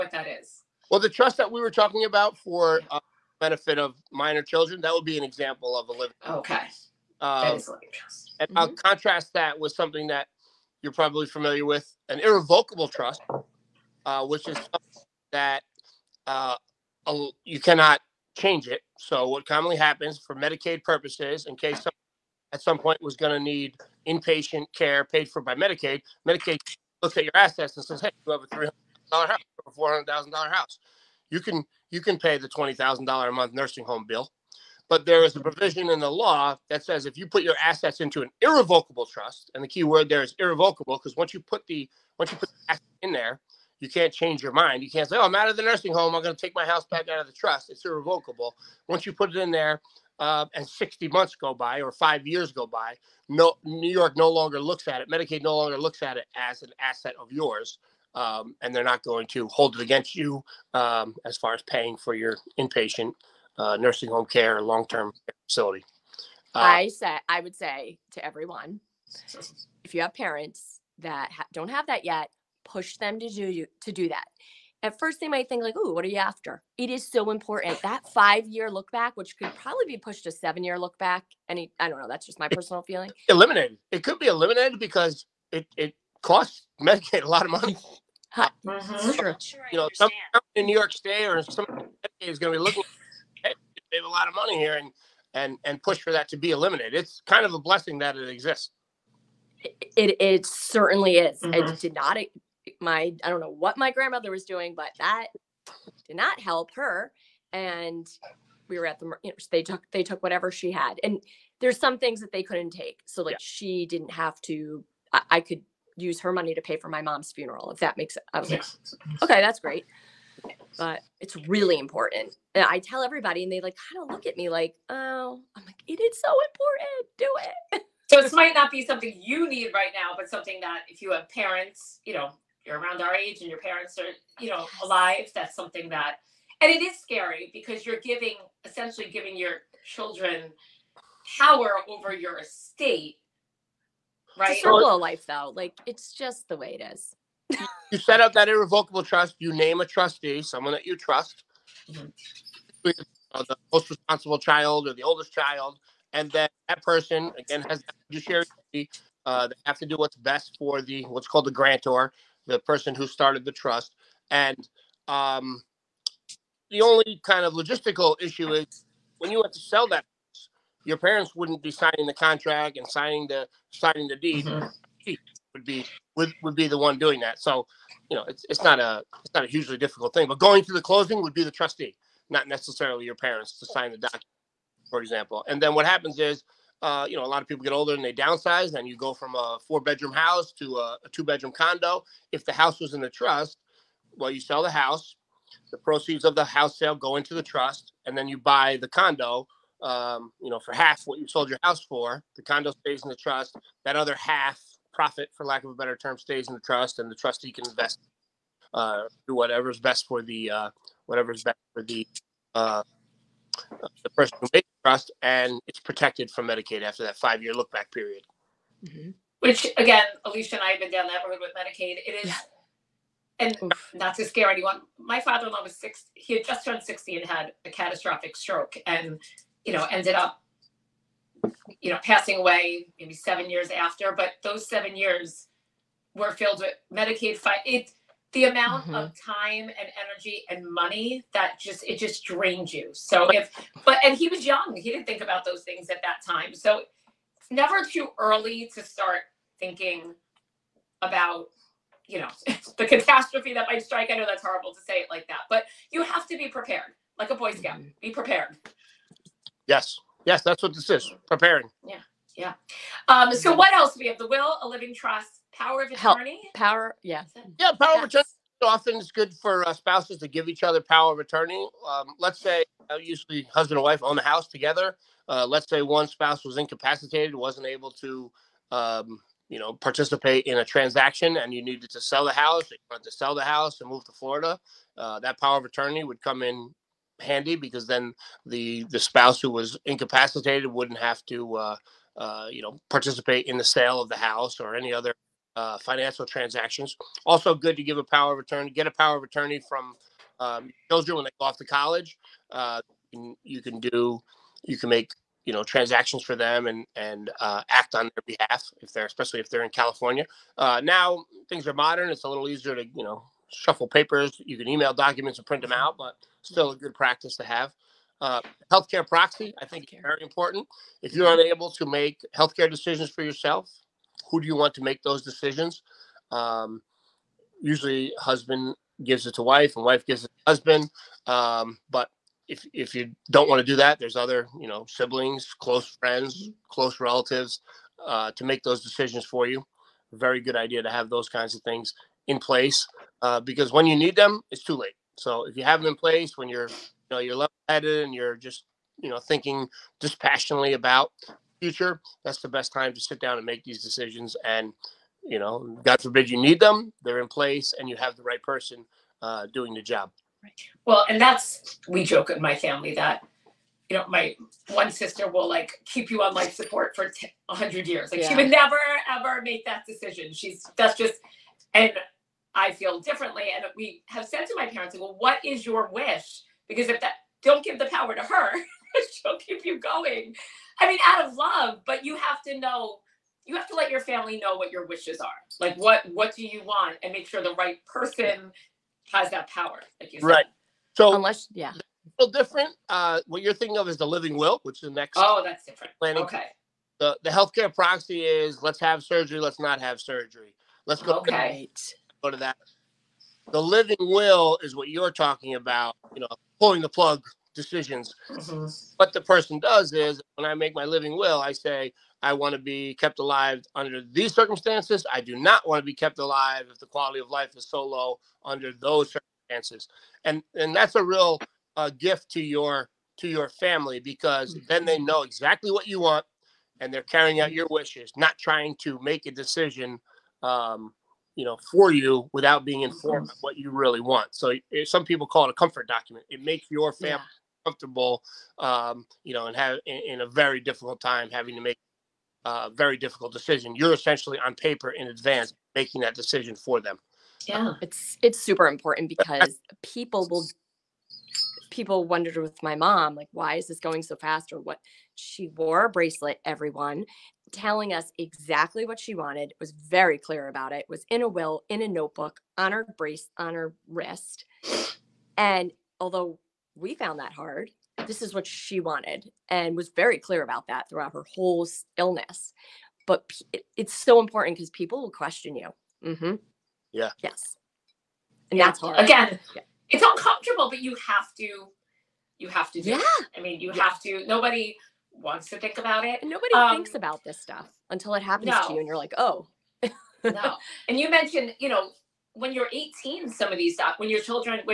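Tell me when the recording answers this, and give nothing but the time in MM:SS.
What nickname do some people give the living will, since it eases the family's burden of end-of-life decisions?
07:15.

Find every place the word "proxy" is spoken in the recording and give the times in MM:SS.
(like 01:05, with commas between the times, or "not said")
05:19, 06:37.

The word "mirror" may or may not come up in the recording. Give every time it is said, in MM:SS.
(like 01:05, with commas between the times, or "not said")
not said.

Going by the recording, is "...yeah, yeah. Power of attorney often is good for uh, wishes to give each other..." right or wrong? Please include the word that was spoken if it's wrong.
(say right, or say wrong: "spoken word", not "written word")
wrong: "spouses", not "wishes".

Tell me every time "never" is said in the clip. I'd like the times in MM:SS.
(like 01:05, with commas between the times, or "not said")
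04:07, 06:08.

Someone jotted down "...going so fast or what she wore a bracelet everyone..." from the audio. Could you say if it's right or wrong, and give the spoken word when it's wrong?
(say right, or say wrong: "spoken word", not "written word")
right.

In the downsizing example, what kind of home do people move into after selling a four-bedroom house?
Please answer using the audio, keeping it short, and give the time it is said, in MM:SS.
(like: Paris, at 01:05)
two bedroom condo, at 03:11.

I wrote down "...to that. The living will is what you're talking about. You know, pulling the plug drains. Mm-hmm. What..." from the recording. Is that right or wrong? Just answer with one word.
wrong.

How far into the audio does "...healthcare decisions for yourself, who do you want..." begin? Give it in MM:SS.
05:22.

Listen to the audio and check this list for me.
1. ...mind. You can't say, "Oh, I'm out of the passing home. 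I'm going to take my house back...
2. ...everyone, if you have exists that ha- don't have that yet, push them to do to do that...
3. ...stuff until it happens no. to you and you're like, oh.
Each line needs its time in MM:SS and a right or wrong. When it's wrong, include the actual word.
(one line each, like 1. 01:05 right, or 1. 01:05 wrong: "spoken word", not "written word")
1. 00:44 wrong: "nursing", not "passing"
2. 01:08 wrong: "parents", not "exists"
3. 08:07 right.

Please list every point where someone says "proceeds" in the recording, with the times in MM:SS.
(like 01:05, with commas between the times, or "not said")
03:15.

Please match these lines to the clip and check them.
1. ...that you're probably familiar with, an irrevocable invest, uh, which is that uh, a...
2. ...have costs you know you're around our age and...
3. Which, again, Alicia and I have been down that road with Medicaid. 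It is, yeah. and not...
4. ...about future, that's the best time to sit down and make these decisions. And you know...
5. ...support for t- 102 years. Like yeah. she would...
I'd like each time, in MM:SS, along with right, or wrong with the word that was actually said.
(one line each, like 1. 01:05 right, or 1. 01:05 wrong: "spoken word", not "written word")
1. 00:10 wrong: "trust", not "invest"
2. 02:11 wrong: "parents", not "costs"
3. 03:39 right
4. 05:50 right
5. 06:06 wrong: "100", not "102".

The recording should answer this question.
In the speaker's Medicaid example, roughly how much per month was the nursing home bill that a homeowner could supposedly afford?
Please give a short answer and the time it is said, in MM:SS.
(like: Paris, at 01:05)
$20,000, at 00:32.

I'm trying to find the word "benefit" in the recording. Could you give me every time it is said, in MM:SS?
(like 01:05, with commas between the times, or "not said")
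00:03.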